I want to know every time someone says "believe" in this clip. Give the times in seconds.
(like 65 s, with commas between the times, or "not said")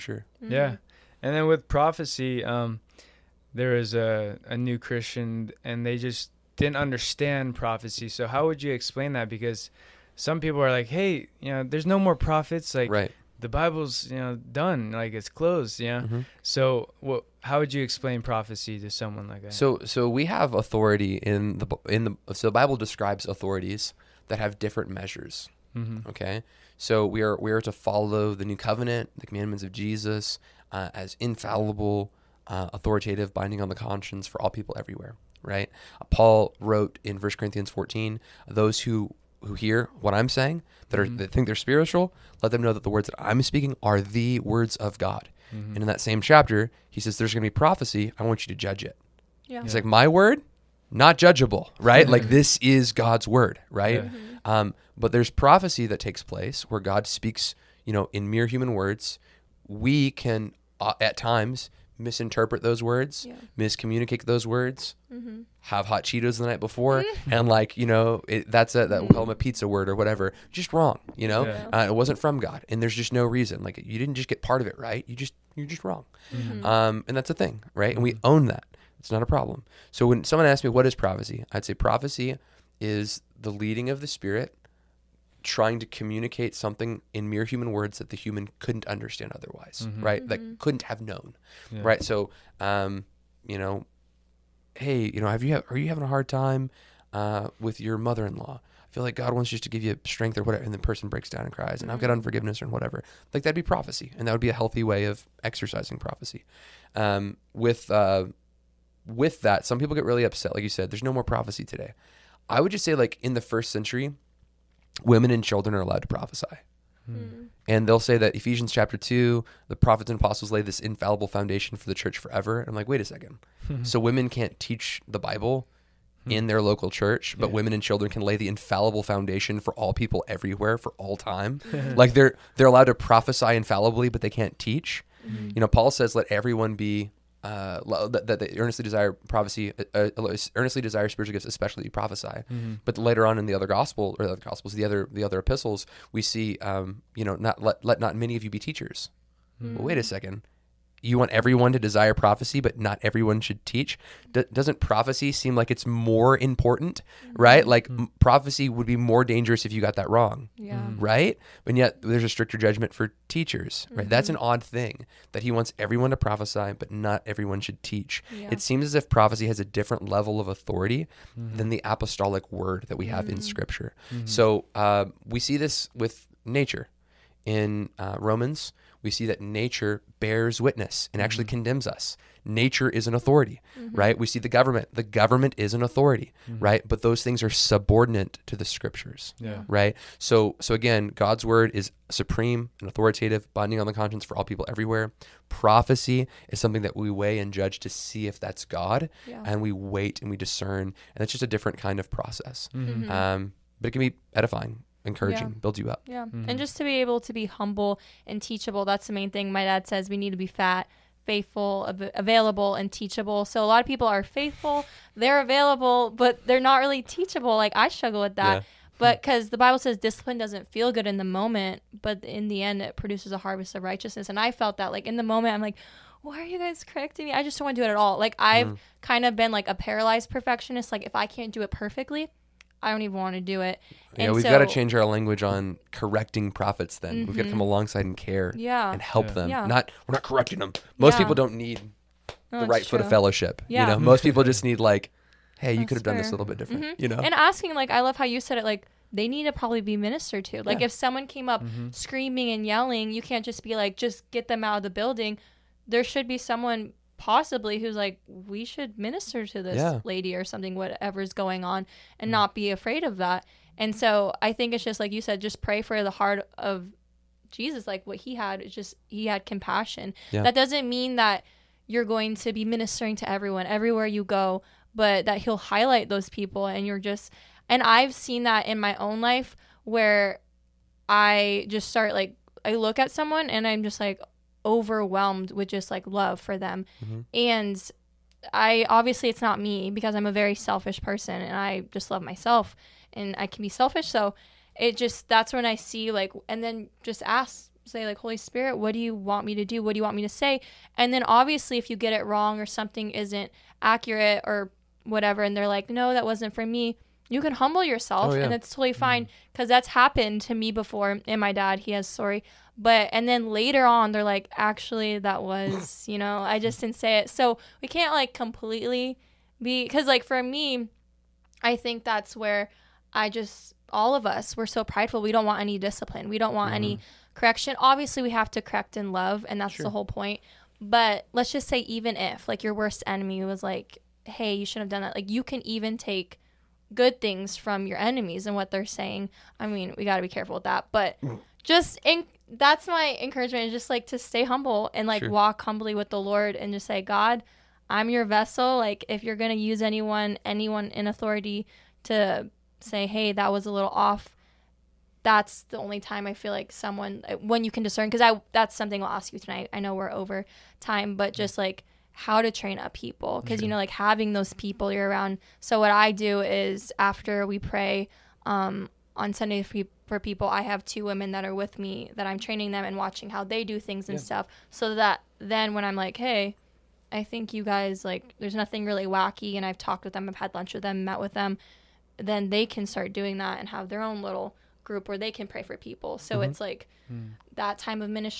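not said.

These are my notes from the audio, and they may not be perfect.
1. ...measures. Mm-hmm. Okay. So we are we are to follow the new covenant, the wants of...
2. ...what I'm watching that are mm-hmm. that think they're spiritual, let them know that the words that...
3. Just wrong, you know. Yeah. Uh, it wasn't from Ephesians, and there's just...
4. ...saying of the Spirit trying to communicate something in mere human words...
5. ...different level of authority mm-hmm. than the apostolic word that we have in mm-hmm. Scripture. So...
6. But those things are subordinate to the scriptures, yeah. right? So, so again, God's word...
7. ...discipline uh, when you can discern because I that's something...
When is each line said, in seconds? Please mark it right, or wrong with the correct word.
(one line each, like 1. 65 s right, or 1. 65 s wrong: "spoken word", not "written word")
1. 24 s wrong: "commandments", not "wants"
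2. 39 s wrong: "saying", not "watching"
3. 70 s wrong: "God", not "Ephesians"
4. 83 s wrong: "leading", not "saying"
5. 169 s right
6. 186 s right
7. 356 s wrong: "someone", not "discipline".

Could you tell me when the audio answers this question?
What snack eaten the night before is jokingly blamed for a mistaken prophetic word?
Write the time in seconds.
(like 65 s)
65 s.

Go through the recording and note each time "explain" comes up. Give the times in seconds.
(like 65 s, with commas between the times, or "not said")
8 s, 17 s.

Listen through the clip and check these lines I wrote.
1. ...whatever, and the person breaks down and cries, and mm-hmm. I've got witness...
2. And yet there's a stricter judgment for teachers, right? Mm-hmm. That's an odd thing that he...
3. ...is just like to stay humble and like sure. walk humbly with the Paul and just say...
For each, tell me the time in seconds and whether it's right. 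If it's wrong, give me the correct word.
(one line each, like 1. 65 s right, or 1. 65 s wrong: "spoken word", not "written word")
1. 100 s wrong: "unforgiveness", not "witness"
2. 161 s right
3. 343 s wrong: "Lord", not "Paul".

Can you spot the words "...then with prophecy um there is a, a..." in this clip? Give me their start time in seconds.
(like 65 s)
1 s.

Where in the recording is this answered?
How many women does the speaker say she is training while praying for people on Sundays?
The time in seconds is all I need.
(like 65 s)
370 s.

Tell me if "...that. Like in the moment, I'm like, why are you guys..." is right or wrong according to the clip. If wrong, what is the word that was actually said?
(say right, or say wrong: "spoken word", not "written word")
right.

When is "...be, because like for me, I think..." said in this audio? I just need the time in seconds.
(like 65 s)
319 s.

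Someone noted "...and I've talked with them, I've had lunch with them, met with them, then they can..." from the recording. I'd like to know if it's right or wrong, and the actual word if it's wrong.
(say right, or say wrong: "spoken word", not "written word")
right.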